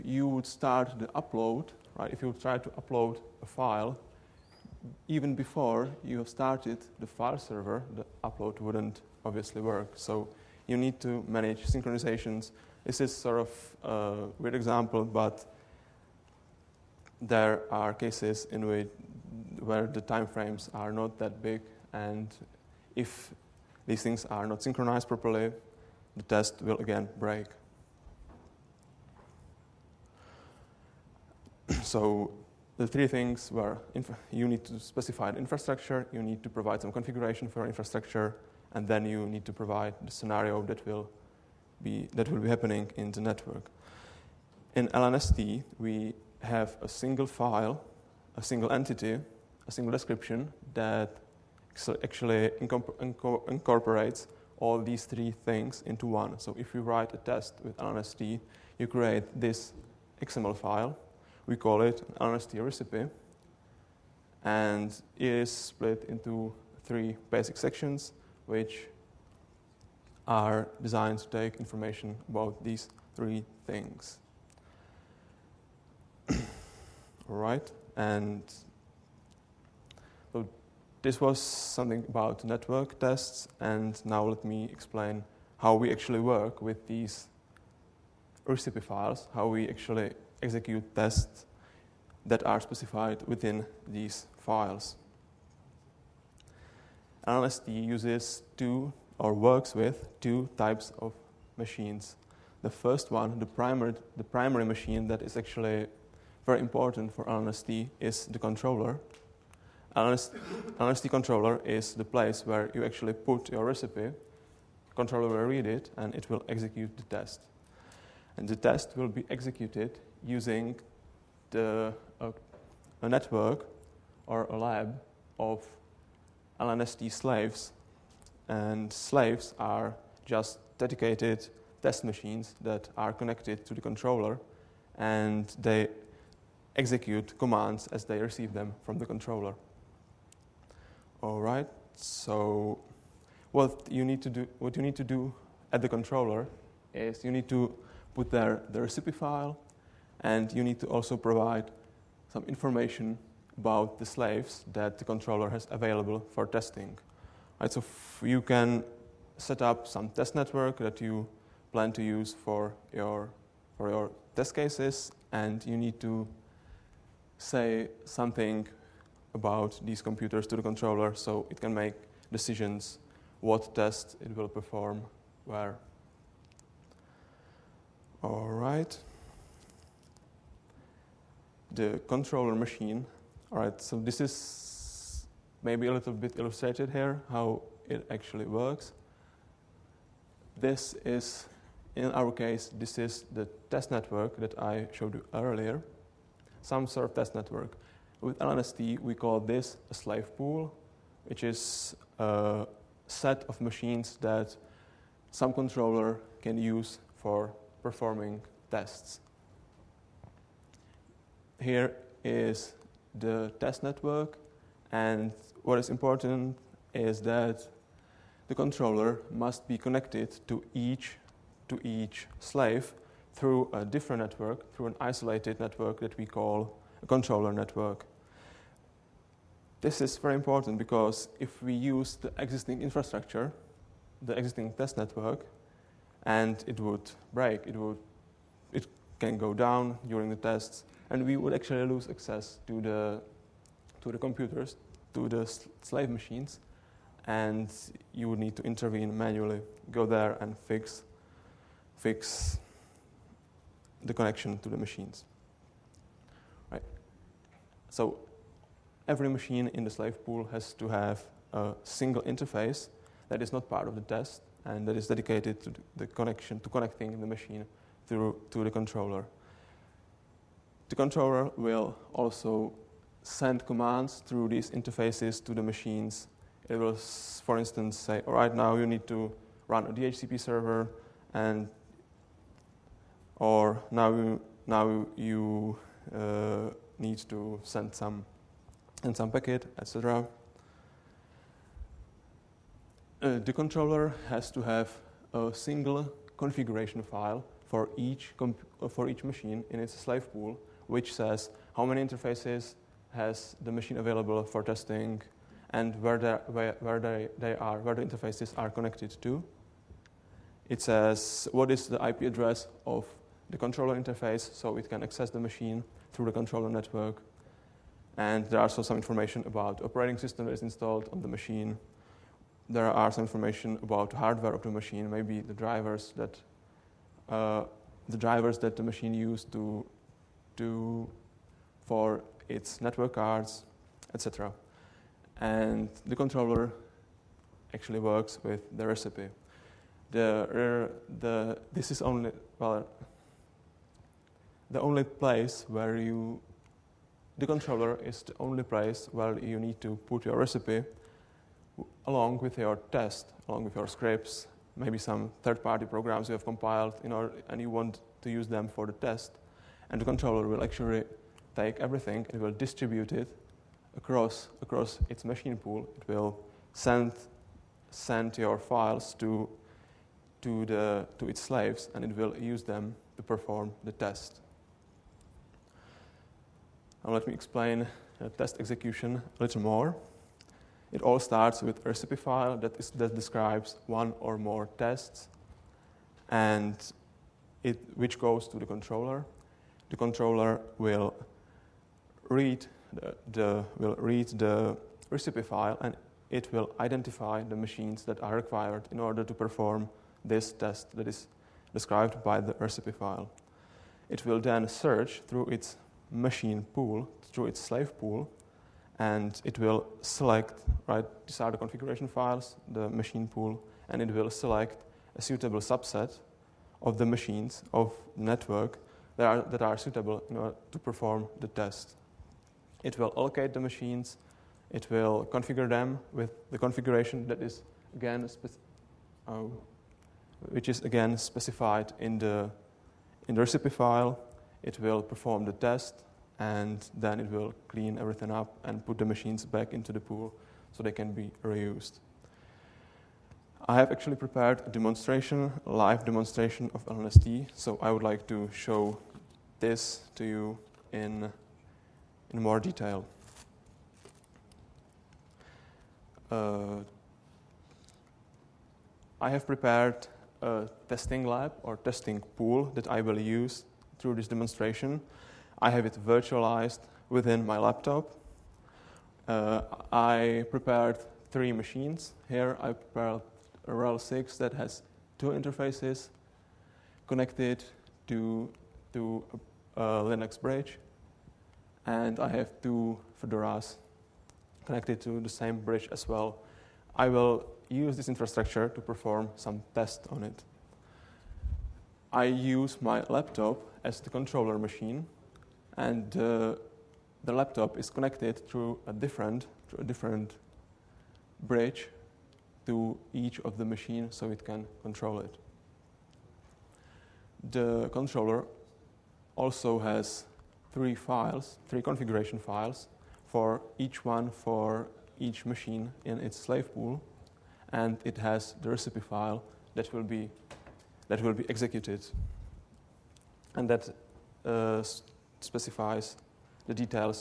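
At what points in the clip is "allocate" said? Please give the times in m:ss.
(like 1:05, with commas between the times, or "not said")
7:03.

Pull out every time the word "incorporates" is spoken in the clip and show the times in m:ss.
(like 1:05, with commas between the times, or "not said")
0:52.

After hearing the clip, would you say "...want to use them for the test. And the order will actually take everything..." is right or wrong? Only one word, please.
wrong.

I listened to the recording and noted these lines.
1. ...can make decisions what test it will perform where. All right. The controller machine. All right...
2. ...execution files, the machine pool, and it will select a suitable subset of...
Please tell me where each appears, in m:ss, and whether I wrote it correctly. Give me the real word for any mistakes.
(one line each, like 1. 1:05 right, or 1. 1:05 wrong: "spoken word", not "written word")
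1. 2:51 right
2. 6:51 wrong: "configuration", not "execution".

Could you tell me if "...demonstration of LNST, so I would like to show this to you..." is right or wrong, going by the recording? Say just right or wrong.
right.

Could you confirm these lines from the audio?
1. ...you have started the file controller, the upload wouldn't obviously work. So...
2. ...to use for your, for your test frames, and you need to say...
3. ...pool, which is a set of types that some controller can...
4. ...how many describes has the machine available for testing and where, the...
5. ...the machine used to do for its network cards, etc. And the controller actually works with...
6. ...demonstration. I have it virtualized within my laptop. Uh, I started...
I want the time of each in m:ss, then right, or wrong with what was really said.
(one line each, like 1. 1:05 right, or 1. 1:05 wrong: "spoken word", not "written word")
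1. 0:06 wrong: "server", not "controller"
2. 2:41 wrong: "cases", not "frames"
3. 3:20 wrong: "machines", not "types"
4. 5:01 wrong: "interfaces", not "describes"
5. 5:28 right
6. 7:44 wrong: "prepared", not "started".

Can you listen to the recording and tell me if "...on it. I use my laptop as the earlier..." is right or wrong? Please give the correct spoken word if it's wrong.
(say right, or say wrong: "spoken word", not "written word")
wrong: "controller", not "earlier".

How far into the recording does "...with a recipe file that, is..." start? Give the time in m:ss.
6:21.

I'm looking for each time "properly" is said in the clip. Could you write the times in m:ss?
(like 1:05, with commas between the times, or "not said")
0:25.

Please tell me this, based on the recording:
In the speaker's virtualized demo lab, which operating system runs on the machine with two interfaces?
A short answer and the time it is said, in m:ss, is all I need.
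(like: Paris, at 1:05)
RHEL6, at 7:53.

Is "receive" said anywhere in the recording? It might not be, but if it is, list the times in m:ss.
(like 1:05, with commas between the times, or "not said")
2:18.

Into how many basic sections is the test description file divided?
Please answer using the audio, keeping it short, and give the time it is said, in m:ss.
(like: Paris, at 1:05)
3, at 1:06.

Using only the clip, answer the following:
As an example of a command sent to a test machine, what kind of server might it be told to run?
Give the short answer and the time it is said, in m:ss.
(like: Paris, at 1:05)
DHCP server, at 4:39.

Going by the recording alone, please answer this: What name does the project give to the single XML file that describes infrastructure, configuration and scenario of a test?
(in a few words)
LNST recipe.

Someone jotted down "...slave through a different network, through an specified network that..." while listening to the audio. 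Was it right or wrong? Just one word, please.
wrong.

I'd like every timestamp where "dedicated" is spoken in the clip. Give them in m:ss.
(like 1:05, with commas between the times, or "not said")
2:10, 4:25.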